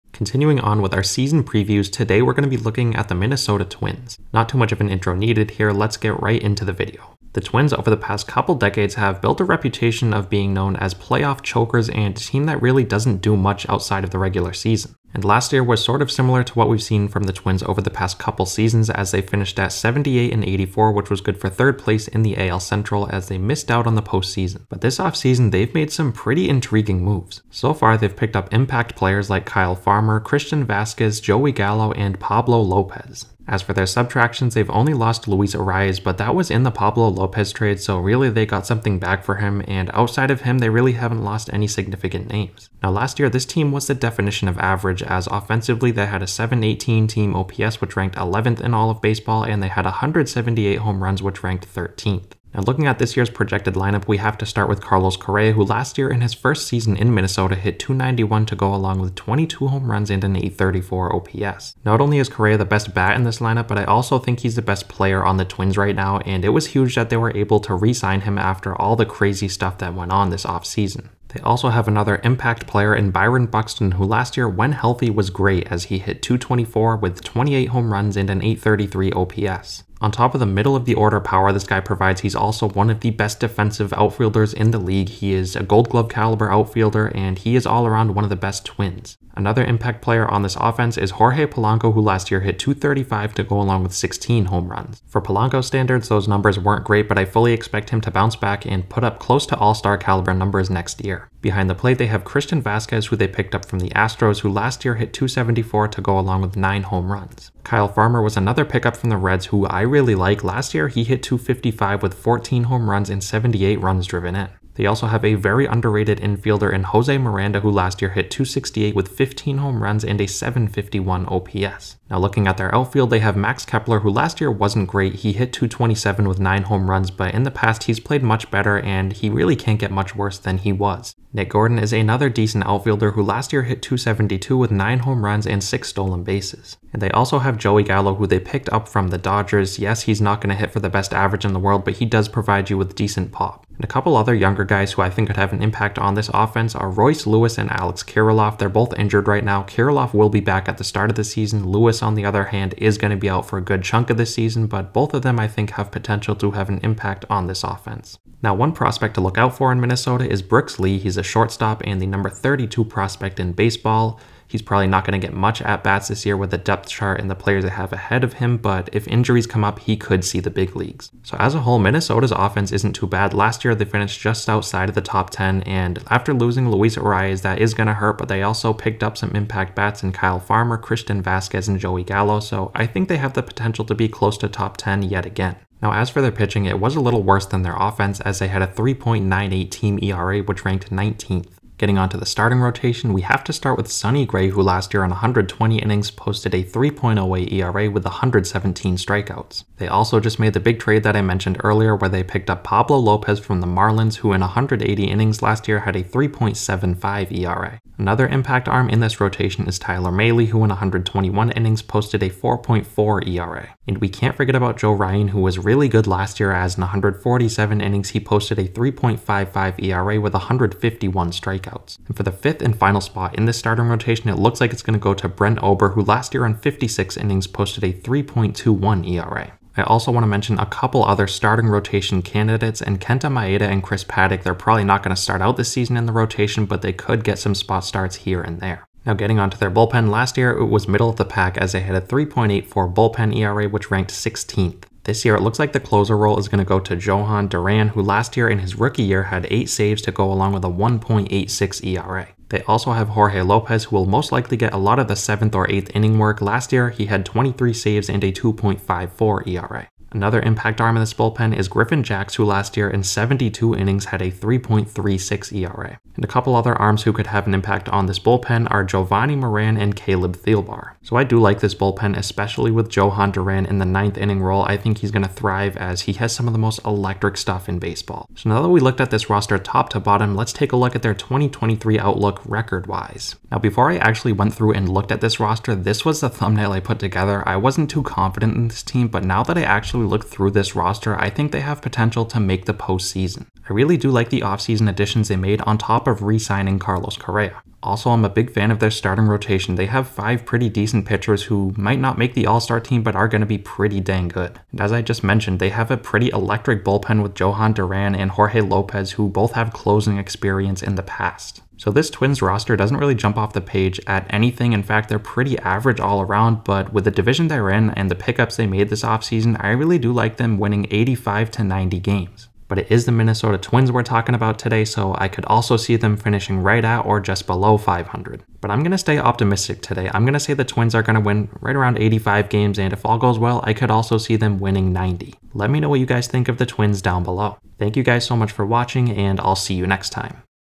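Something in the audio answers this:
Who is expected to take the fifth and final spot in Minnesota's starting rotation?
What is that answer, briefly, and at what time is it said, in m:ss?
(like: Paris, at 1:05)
Brent Ober, at 3:45.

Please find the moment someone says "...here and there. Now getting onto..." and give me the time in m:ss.
3:58.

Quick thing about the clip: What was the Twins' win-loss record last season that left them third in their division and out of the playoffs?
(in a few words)
78-84.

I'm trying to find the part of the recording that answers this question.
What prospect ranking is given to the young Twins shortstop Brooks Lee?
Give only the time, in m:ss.
2:42.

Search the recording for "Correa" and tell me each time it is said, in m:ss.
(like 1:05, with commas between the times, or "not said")
0:55, 1:02, 4:57.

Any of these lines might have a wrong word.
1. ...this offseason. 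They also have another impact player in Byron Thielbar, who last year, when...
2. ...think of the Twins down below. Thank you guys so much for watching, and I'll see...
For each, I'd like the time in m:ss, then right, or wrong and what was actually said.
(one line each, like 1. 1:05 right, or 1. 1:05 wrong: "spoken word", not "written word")
1. 1:10 wrong: "Buxton", not "Thielbar"
2. 5:36 right.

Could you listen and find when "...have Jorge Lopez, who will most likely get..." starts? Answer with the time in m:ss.
4:12.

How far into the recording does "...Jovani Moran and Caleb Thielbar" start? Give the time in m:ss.
4:28.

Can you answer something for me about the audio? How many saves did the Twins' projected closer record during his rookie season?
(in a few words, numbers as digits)
8.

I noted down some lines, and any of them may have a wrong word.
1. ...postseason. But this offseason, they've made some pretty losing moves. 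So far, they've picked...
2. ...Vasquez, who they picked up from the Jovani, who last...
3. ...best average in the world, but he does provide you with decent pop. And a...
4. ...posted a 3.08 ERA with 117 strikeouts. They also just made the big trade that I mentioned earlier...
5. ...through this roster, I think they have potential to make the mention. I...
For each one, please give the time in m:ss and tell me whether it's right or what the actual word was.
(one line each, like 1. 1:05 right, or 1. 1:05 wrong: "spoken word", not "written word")
1. 0:24 wrong: "intriguing", not "losing"
2. 1:42 wrong: "Astros", not "Jovani"
3. 2:20 right
4. 3:16 right
5. 4:50 wrong: "postseason", not "mention".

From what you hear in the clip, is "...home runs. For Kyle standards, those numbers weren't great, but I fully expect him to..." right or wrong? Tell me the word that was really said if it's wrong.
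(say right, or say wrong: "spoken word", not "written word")
wrong: "Polanco", not "Kyle".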